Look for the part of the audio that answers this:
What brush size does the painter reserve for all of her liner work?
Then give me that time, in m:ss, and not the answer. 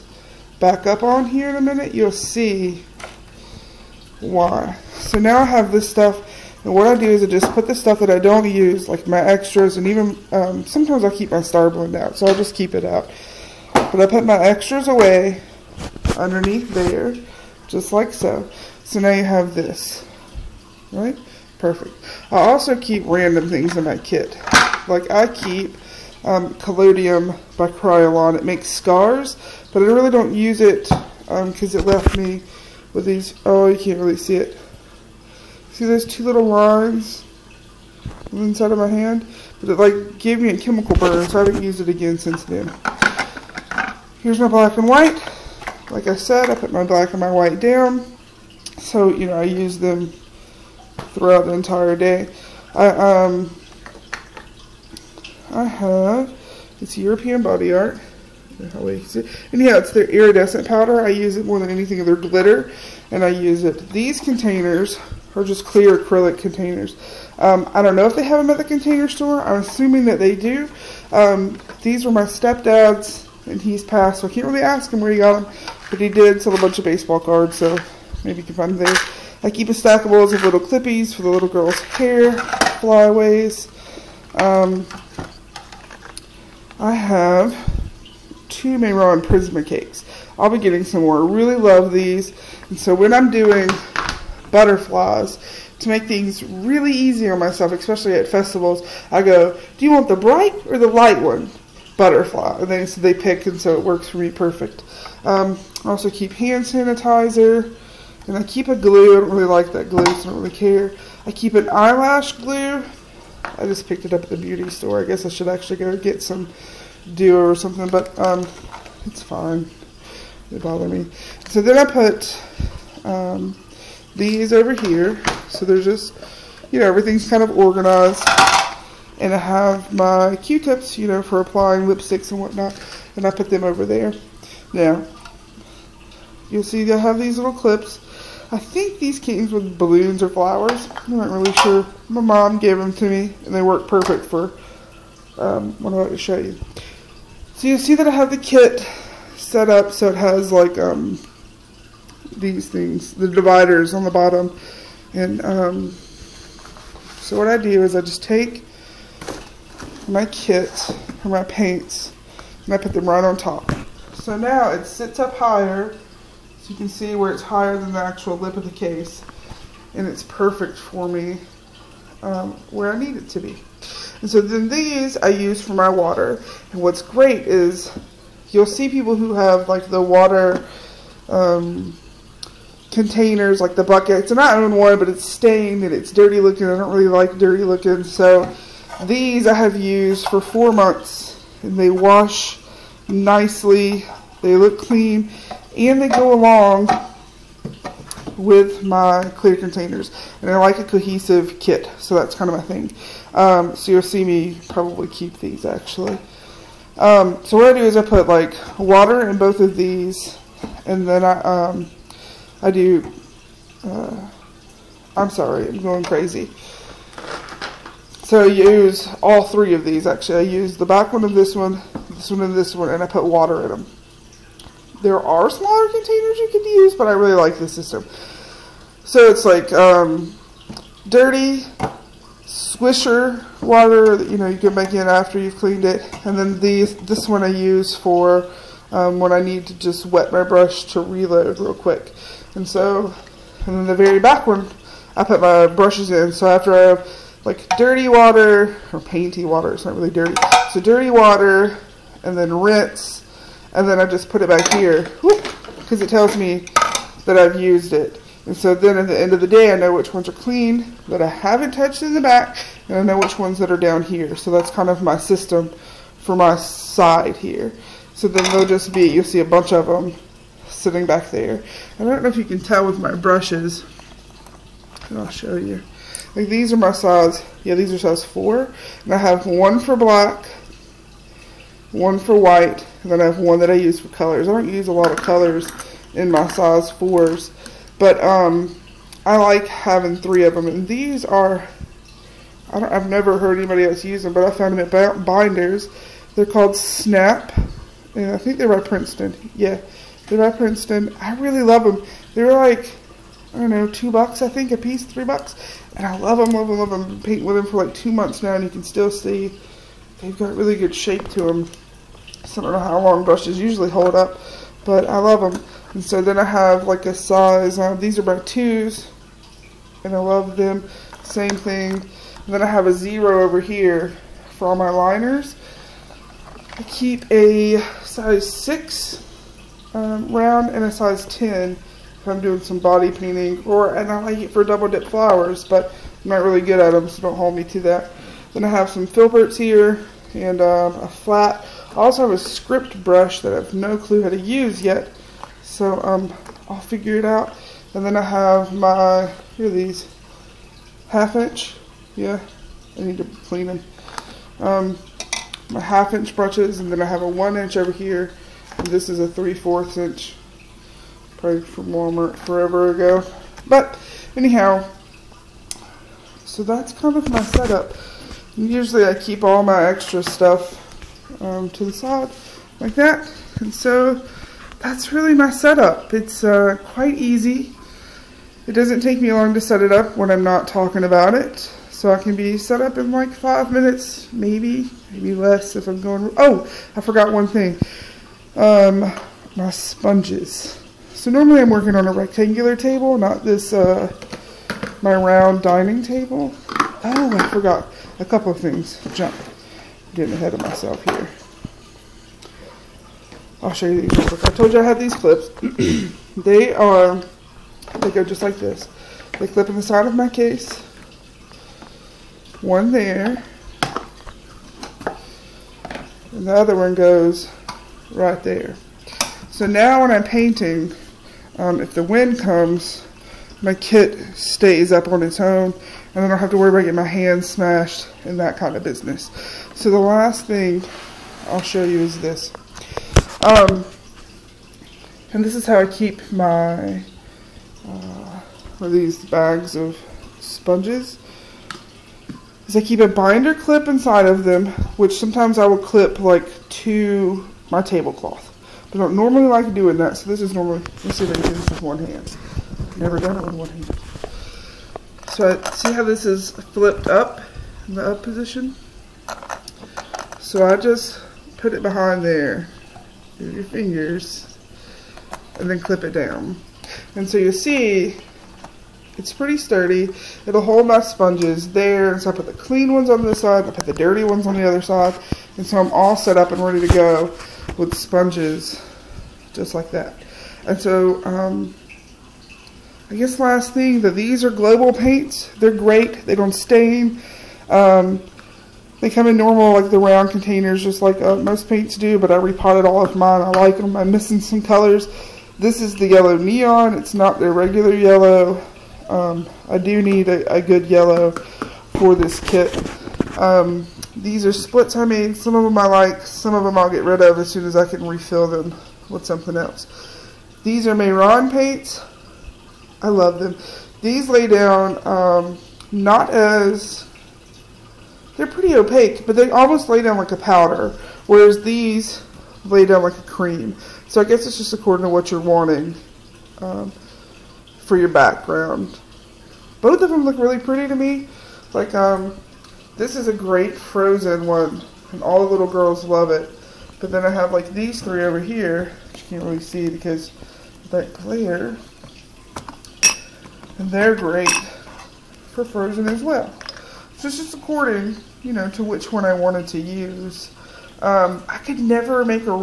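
5:22.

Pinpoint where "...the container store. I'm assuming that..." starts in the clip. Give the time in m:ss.
1:08.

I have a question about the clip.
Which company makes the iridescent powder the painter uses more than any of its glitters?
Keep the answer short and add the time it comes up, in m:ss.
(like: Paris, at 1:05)
European Body Art, at 0:56.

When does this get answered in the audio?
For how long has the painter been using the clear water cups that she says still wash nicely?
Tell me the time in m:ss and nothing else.
3:10.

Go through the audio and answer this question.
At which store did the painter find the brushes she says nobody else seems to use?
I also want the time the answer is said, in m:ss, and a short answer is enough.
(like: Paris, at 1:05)
Binders, at 4:55.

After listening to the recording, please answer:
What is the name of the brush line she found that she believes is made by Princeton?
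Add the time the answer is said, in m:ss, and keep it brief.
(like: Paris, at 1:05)
Snap, at 4:56.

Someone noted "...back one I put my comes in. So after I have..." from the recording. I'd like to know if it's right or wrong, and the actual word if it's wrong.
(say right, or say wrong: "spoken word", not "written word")
wrong: "brushes", not "comes".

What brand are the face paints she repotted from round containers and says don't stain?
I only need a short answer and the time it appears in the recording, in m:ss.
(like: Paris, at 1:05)
Global, at 8:04.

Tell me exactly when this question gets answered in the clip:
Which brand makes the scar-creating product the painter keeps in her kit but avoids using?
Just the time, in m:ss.
0:27.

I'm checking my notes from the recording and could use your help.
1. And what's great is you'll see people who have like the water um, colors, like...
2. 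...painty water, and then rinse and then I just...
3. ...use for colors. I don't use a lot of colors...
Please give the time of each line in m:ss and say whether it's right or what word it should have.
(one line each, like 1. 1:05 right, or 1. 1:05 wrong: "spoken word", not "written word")
1. 2:56 wrong: "containers", not "colors"
2. 4:10 wrong: "dirty", not "painty"
3. 4:43 right.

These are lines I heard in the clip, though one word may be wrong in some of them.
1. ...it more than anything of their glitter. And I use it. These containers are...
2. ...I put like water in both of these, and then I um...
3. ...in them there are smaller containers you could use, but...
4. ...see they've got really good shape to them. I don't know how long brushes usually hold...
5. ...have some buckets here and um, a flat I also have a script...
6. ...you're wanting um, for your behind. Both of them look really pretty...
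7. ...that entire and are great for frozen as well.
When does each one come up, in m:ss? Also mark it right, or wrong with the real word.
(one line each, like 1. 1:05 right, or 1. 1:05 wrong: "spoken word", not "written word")
1. 1:01 right
2. 3:27 right
3. 3:43 right
4. 5:09 right
5. 5:38 wrong: "filberts", not "buckets"
6. 8:45 wrong: "background", not "behind"
7. 9:00 wrong: "glare", not "entire".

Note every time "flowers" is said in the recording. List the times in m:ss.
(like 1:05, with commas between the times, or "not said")
2:20, 5:35.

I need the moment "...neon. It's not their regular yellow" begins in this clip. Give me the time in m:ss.
8:16.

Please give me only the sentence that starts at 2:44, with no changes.
So now it sits up higher so you can see where it's higher than the actual lip of the case.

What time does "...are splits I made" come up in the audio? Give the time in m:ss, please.
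8:24.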